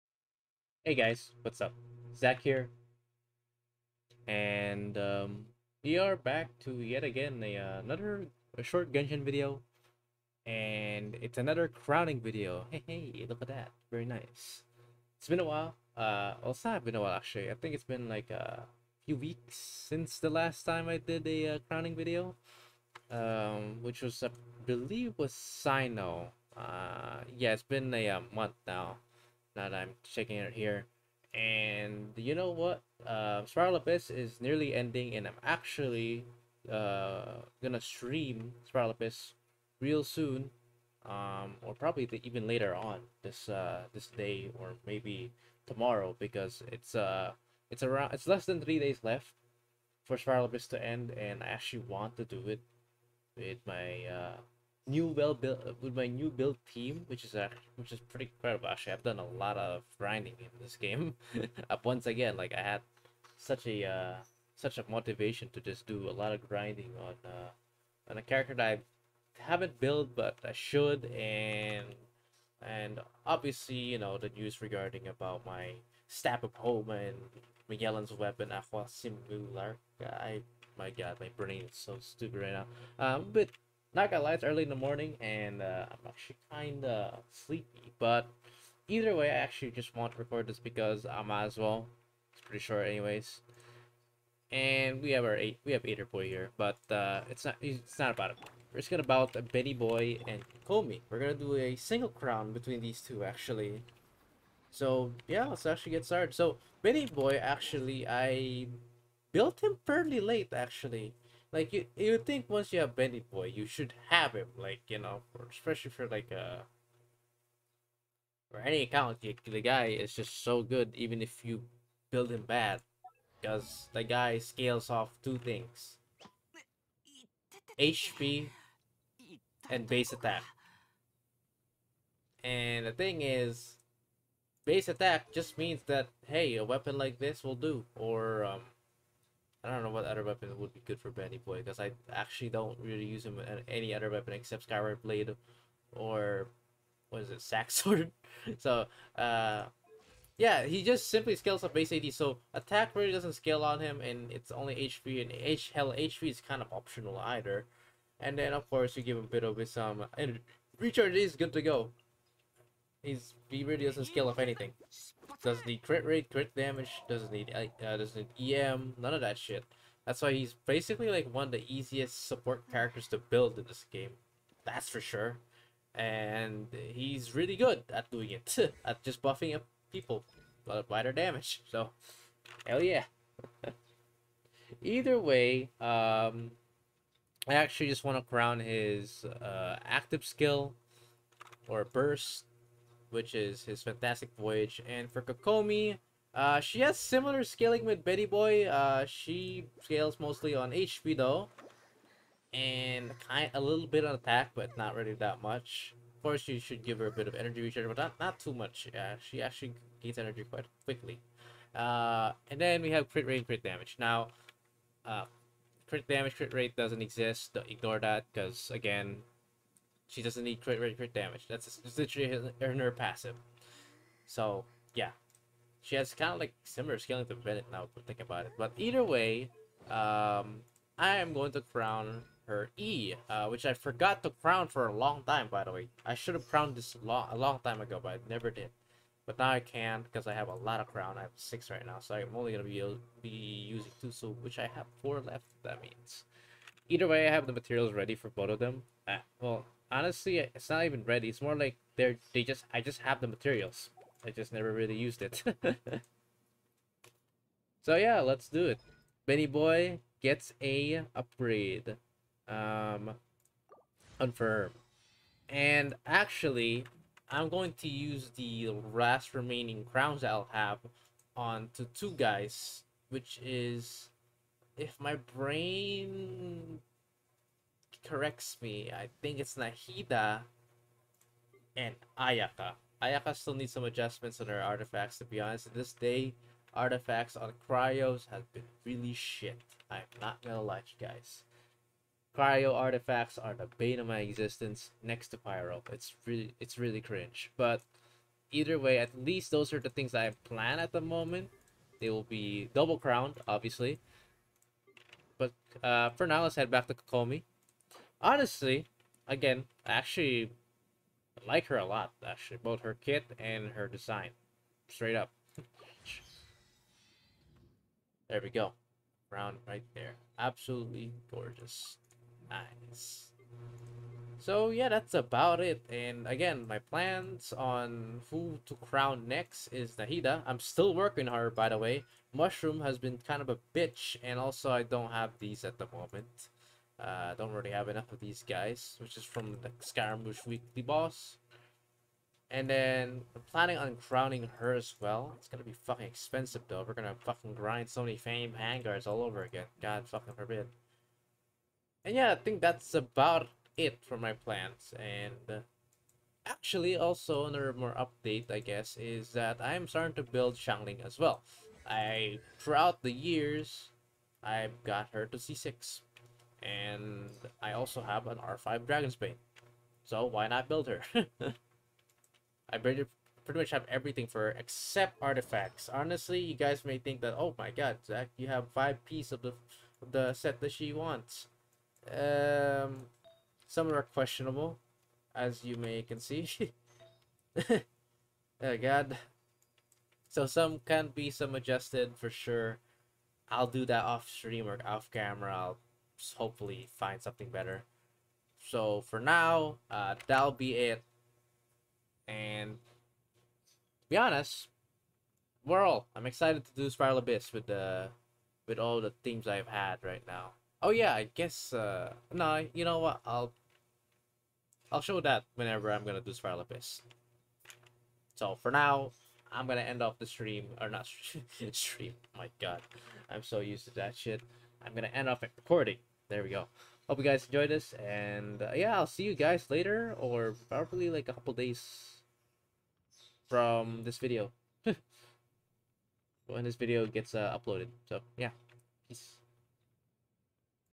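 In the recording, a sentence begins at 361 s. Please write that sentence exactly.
I throughout the years, I've got her to C6 and I also have an R5 Dragonsbane.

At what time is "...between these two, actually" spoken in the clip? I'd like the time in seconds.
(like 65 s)
102 s.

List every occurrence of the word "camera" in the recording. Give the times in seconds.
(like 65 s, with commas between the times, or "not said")
395 s.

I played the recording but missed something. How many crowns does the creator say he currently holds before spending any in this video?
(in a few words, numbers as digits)
6.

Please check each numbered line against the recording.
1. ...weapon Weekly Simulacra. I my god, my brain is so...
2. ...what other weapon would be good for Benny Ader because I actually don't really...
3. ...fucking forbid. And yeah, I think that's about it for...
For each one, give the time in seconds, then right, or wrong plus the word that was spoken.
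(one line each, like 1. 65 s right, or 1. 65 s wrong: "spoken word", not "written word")
1. 78 s wrong: "Aqua", not "Weekly"
2. 139 s wrong: "Boy", not "Ader"
3. 350 s right.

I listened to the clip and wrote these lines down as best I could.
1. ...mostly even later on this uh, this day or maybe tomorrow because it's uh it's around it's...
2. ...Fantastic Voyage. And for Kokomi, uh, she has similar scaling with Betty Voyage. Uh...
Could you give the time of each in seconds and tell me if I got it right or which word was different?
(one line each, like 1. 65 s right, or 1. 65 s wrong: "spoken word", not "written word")
1. 41 s wrong: "probably", not "mostly"
2. 193 s wrong: "Boy", not "Voyage".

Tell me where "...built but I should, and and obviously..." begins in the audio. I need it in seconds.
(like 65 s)
69 s.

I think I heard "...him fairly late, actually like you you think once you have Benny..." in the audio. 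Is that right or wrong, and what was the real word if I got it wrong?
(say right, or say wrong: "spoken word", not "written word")
right.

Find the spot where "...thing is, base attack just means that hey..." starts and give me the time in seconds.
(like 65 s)
132 s.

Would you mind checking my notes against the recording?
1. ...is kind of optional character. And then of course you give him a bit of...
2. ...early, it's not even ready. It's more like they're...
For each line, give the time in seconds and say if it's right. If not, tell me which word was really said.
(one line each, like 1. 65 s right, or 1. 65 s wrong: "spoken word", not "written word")
1. 156 s wrong: "either", not "character"
2. 249 s wrong: "honestly", not "early".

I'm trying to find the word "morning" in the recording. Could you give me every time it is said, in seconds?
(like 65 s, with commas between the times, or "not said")
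84 s.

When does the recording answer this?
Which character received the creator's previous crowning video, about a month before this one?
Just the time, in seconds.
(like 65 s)
25 s.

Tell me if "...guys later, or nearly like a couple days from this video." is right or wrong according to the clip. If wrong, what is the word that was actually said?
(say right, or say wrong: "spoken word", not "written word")
wrong: "probably", not "nearly".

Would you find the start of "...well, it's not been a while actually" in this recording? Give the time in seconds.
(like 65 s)
16 s.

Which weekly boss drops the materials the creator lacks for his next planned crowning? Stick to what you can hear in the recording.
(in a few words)
Scaramouche.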